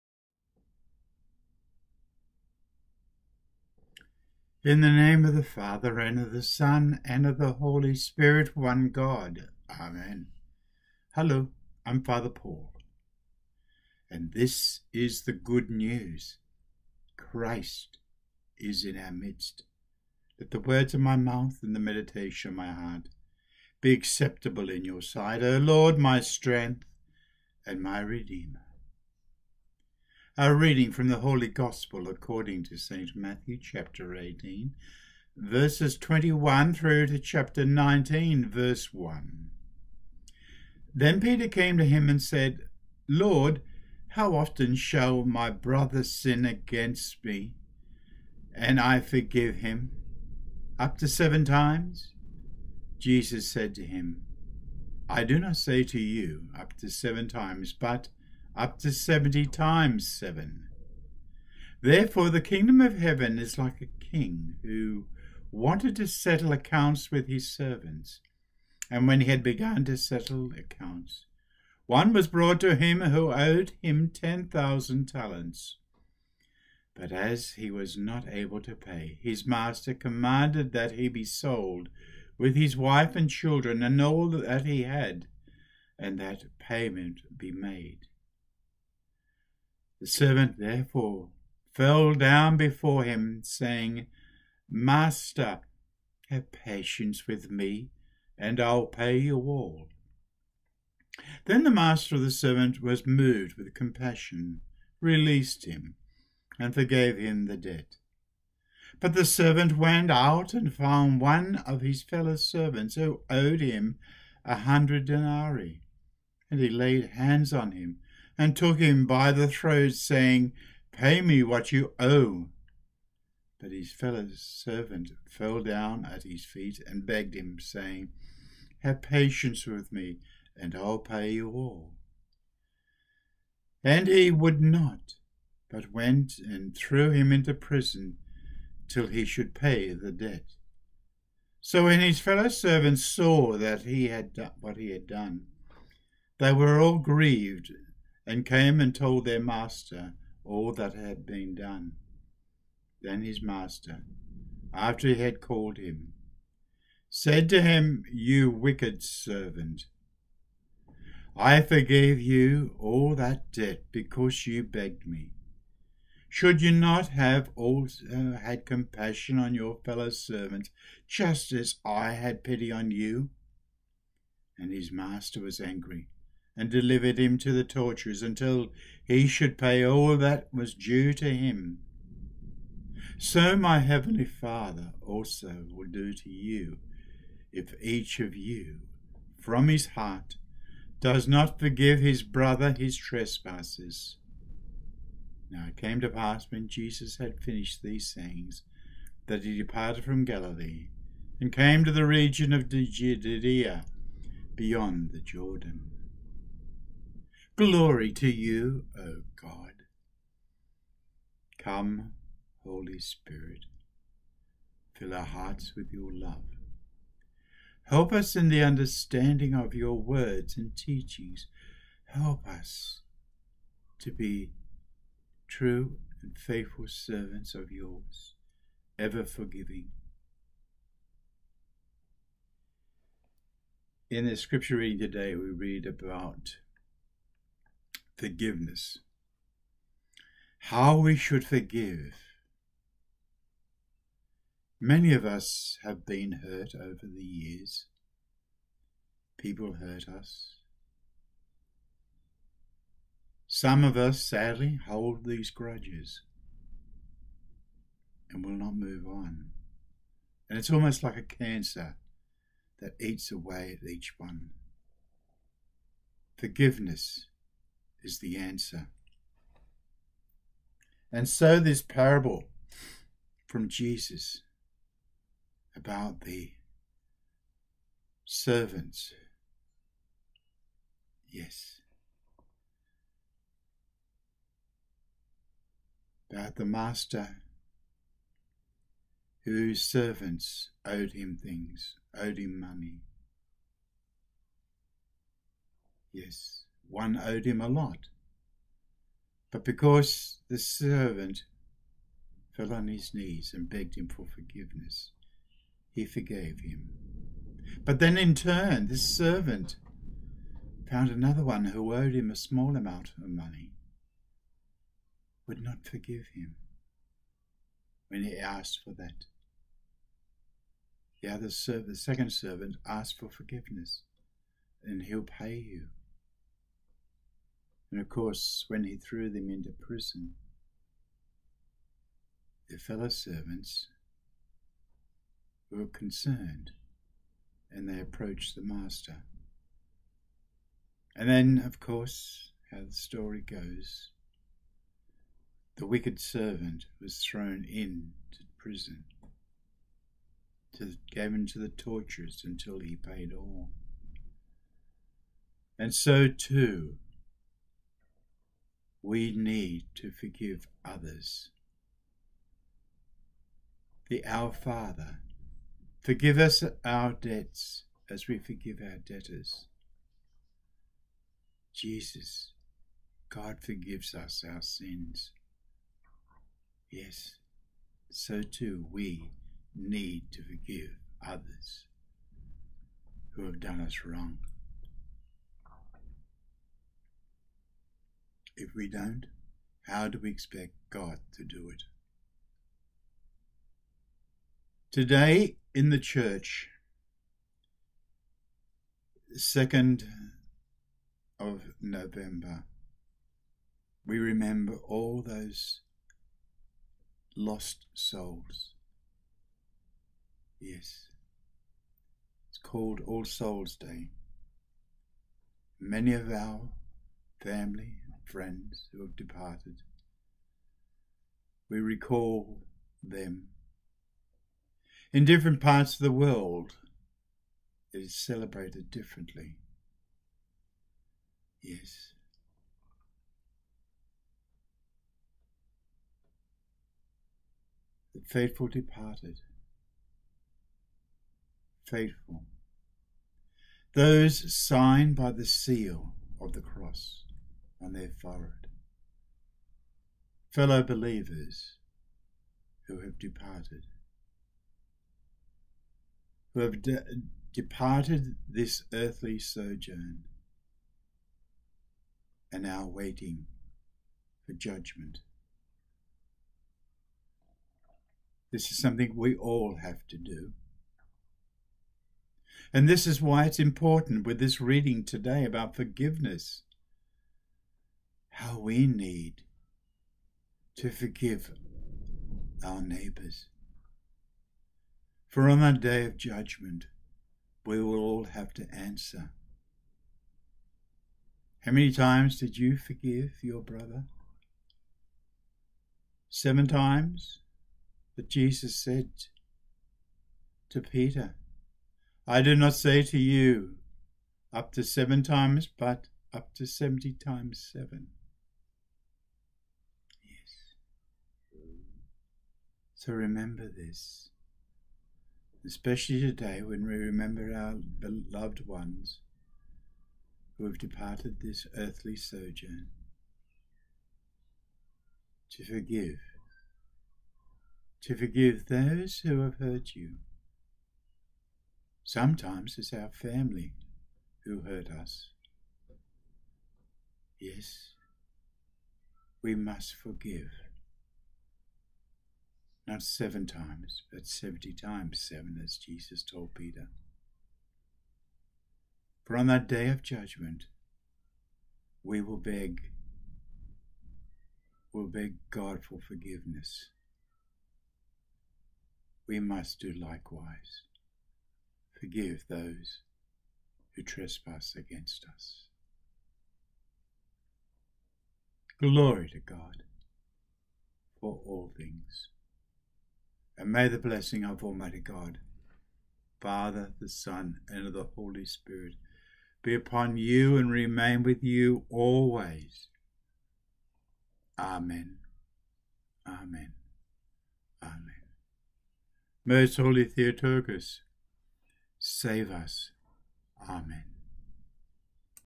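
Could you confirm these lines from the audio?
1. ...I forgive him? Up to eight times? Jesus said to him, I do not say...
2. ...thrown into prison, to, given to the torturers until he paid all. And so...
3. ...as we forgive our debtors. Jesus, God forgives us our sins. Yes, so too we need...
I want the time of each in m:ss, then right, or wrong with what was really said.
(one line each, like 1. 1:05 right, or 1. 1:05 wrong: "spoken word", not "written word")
1. 0:48 wrong: "seven", not "eight"
2. 5:47 right
3. 6:08 right.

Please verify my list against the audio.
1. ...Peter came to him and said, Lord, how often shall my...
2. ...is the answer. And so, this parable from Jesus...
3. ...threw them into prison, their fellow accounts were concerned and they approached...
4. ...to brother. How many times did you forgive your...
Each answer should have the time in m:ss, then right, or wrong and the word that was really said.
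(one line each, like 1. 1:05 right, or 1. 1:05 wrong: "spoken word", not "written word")
1. 0:41 right
2. 4:28 right
3. 5:28 wrong: "servants", not "accounts"
4. 8:08 wrong: "answer", not "brother".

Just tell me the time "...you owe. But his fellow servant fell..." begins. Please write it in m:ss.
2:01.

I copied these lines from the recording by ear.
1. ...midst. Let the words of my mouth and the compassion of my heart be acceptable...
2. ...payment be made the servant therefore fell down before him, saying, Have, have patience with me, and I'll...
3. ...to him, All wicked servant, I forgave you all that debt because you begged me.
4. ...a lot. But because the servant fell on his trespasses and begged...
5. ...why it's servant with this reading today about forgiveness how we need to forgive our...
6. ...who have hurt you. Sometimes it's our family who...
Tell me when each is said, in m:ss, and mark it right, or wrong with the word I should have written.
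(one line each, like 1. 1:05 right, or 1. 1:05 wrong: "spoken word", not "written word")
1. 0:19 wrong: "meditation", not "compassion"
2. 1:26 wrong: "Master", not "Have"
3. 2:37 wrong: "You", not "All"
4. 4:57 wrong: "knees", not "trespasses"
5. 7:53 wrong: "important", not "servant"
6. 8:49 right.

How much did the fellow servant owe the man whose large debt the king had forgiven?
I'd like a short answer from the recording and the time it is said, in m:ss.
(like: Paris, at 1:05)
100 denarii, at 1:54.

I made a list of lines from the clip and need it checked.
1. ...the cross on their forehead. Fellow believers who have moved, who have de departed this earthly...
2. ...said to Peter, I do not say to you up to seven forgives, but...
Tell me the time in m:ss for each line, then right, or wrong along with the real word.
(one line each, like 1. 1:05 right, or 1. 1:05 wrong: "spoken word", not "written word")
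1. 7:26 wrong: "departed", not "moved"
2. 8:18 wrong: "times", not "forgives".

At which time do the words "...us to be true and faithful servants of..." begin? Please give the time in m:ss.
3:42.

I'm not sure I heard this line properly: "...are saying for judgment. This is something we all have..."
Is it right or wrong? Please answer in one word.
wrong.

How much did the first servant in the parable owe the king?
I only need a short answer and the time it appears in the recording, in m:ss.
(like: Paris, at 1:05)
10,000 talents, at 1:14.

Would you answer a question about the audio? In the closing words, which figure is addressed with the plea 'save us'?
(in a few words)
Most holy Theotokos.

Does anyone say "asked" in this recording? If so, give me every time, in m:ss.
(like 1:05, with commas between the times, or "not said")
5:18, 5:22.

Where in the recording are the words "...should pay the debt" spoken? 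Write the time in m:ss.
2:19.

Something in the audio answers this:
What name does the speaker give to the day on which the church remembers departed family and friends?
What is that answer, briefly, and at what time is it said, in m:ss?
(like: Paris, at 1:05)
All Souls Day, at 6:53.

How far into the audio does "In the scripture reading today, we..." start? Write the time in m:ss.
3:54.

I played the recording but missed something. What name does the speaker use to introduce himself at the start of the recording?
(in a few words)
Father Paul.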